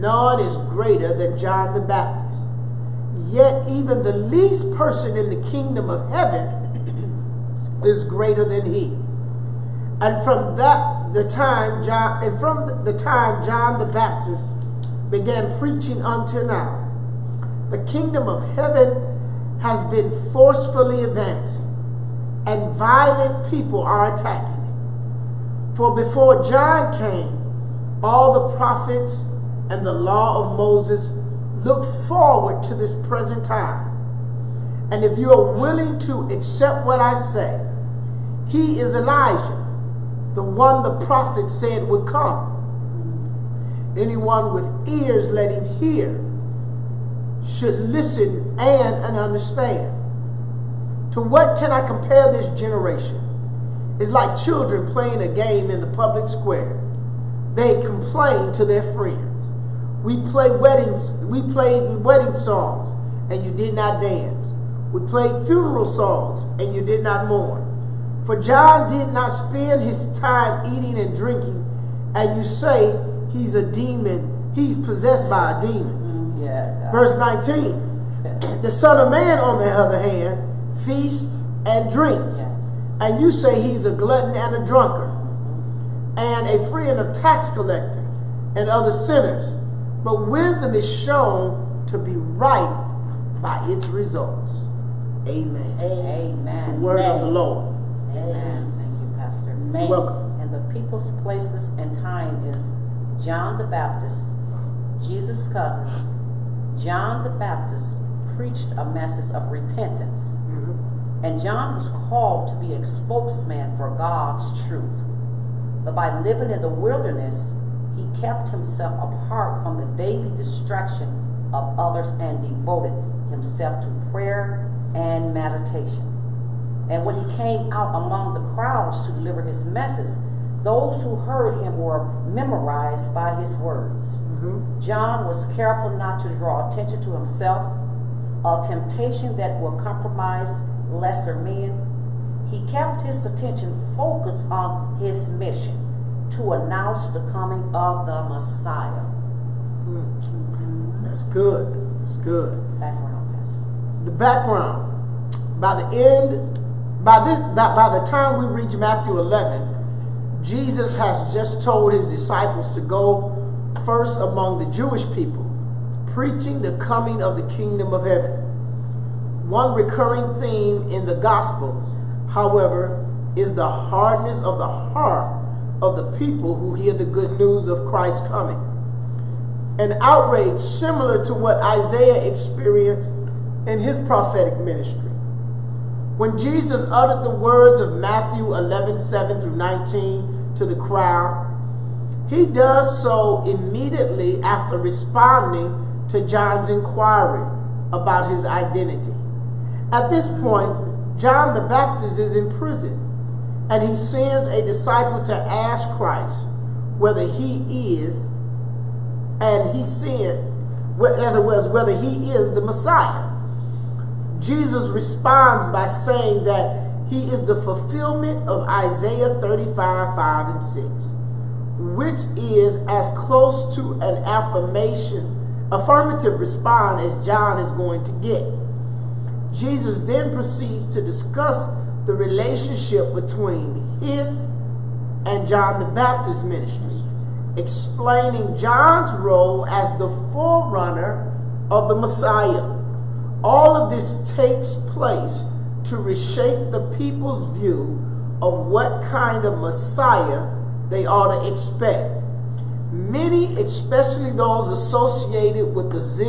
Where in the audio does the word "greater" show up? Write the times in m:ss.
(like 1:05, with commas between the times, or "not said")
0:00, 0:08.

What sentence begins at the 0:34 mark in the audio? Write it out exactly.
And if you are willing to accept what I say, he is Elijah, the one the prophet said would come.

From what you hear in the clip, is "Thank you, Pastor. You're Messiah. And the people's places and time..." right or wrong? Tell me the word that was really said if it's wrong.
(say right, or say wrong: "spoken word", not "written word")
wrong: "Welcome", not "Messiah".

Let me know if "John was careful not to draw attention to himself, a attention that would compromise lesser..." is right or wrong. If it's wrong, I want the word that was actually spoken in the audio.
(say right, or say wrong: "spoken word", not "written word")
wrong: "temptation", not "attention".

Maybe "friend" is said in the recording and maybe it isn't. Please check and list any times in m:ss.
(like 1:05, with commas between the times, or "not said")
0:58, 1:26.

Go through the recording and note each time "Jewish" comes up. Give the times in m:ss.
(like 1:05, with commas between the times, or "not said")
2:44.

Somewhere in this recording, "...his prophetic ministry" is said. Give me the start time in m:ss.
3:03.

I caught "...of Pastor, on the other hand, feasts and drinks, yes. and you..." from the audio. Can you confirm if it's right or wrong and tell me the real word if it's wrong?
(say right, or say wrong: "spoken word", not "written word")
wrong: "Man", not "Pastor".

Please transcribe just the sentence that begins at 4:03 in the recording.
All of this takes place to reshape the people's view of what kind of Messiah they ought to expect.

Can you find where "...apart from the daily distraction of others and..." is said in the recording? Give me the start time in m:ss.
1:59.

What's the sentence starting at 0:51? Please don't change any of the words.
To what can I compare this generation?